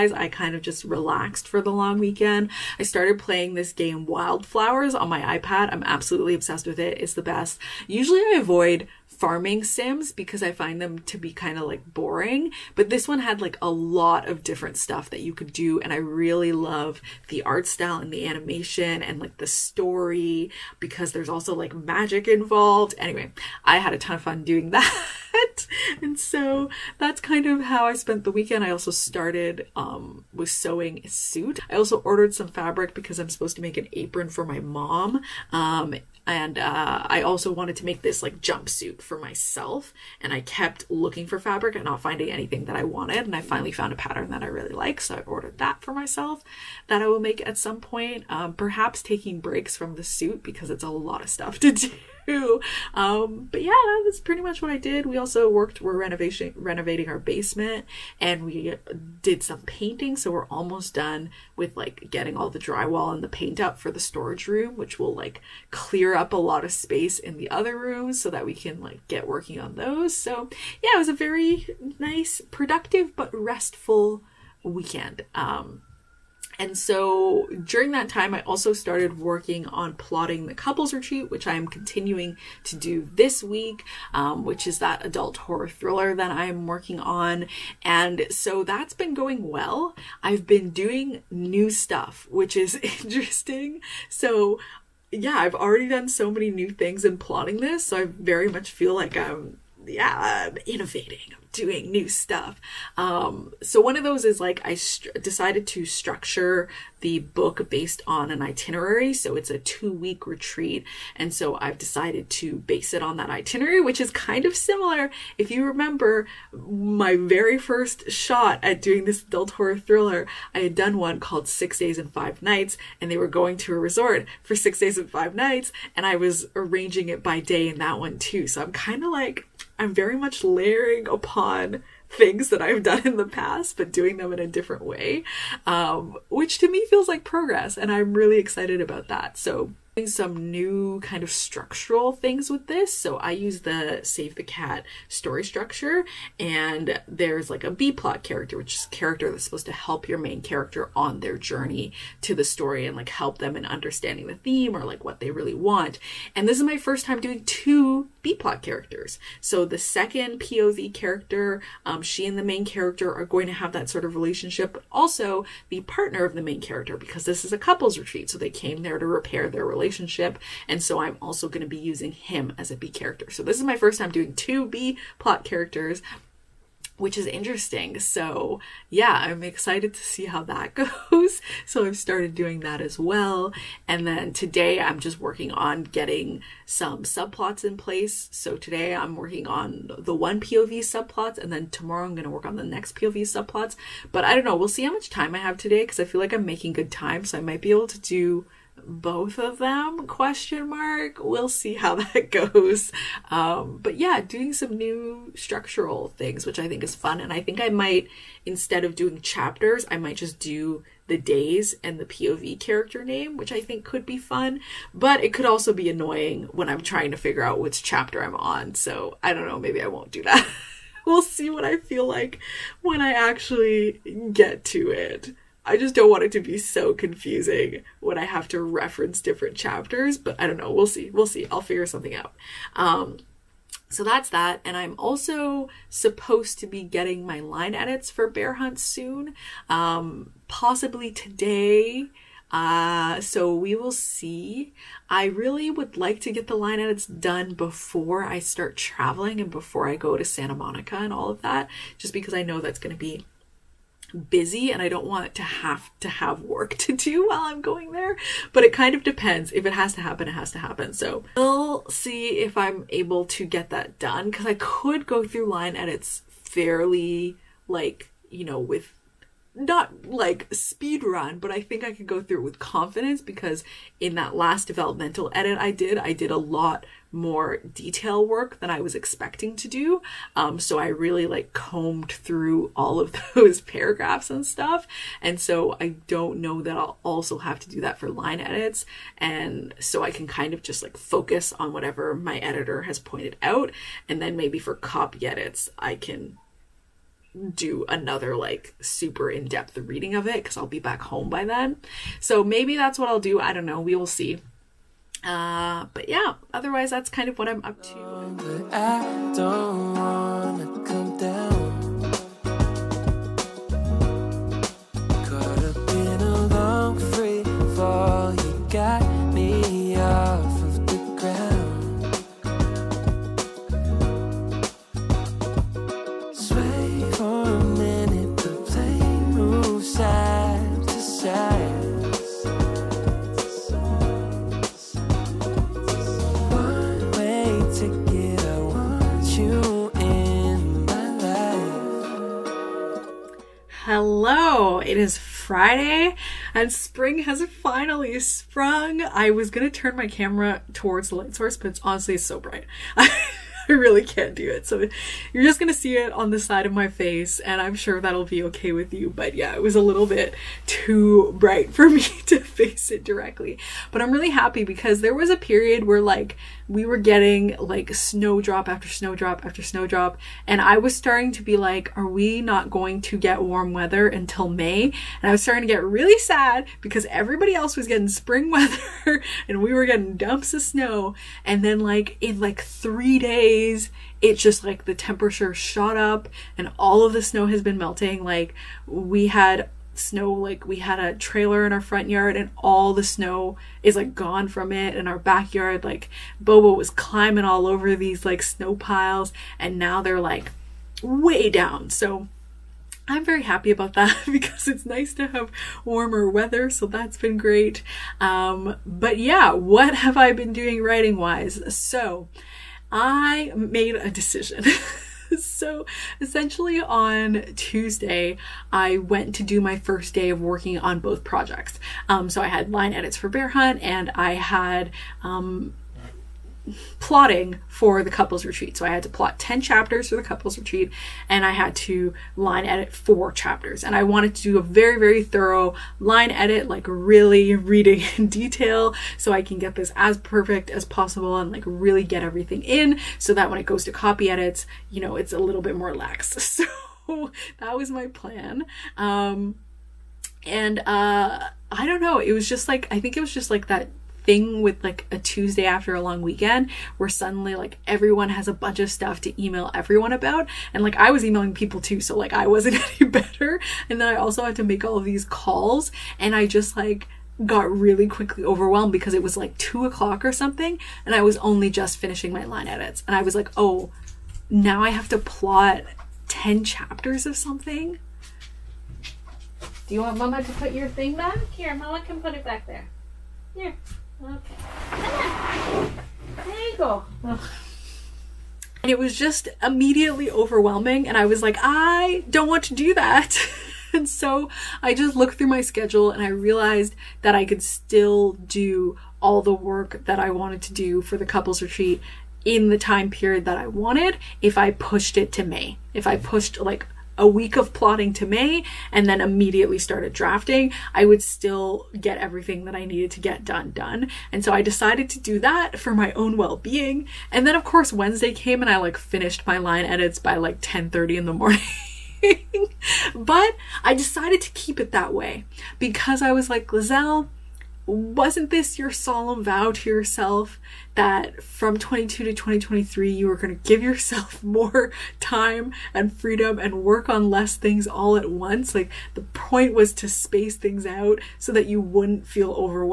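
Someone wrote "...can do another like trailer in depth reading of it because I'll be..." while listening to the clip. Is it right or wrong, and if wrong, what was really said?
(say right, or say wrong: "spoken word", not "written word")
wrong: "super", not "trailer".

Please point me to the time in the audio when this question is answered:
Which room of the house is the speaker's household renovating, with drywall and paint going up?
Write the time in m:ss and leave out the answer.
0:57.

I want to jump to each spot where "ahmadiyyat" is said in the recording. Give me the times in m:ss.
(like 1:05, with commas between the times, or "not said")
not said.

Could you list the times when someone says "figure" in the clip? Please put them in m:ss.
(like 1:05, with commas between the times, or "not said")
3:37, 3:51.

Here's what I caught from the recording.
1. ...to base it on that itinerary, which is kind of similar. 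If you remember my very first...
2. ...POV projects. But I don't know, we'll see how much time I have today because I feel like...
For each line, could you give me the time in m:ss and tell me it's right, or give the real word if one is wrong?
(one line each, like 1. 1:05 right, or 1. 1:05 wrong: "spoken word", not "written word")
1. 1:52 right
2. 3:12 wrong: "subplots", not "projects".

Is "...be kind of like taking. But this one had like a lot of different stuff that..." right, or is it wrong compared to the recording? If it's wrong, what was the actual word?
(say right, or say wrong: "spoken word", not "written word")
wrong: "boring", not "taking".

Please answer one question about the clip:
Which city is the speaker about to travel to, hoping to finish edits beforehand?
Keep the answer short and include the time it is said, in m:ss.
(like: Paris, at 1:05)
Santa Monica, at 4:10.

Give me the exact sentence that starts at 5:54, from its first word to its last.
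So you're just gonna see it on the side of my face, and I'm sure that'll be okay with you.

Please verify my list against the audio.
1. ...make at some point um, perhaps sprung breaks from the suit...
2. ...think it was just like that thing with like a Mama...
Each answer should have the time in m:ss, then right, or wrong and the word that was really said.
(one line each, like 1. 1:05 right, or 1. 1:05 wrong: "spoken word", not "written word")
1. 0:47 wrong: "taking", not "sprung"
2. 7:32 wrong: "Tuesday", not "Mama".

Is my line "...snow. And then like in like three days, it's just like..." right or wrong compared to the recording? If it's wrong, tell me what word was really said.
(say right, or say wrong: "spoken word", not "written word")
right.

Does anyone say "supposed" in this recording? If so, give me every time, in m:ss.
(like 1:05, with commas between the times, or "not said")
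0:33, 2:29, 3:55.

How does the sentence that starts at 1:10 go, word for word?
So yeah, it was a very nice, productive, but restful weekend.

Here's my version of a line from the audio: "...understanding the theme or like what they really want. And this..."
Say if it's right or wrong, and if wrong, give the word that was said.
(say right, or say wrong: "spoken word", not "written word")
right.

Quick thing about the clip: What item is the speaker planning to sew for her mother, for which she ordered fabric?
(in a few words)
An apron.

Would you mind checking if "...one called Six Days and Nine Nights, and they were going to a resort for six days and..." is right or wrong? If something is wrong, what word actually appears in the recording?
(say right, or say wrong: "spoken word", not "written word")
wrong: "Five", not "Nine".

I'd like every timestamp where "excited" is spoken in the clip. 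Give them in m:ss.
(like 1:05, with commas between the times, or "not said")
2:18, 2:59.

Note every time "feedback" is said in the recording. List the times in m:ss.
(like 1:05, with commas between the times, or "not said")
not said.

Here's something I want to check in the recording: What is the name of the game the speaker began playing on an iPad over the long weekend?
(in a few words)
Wylde Flowers.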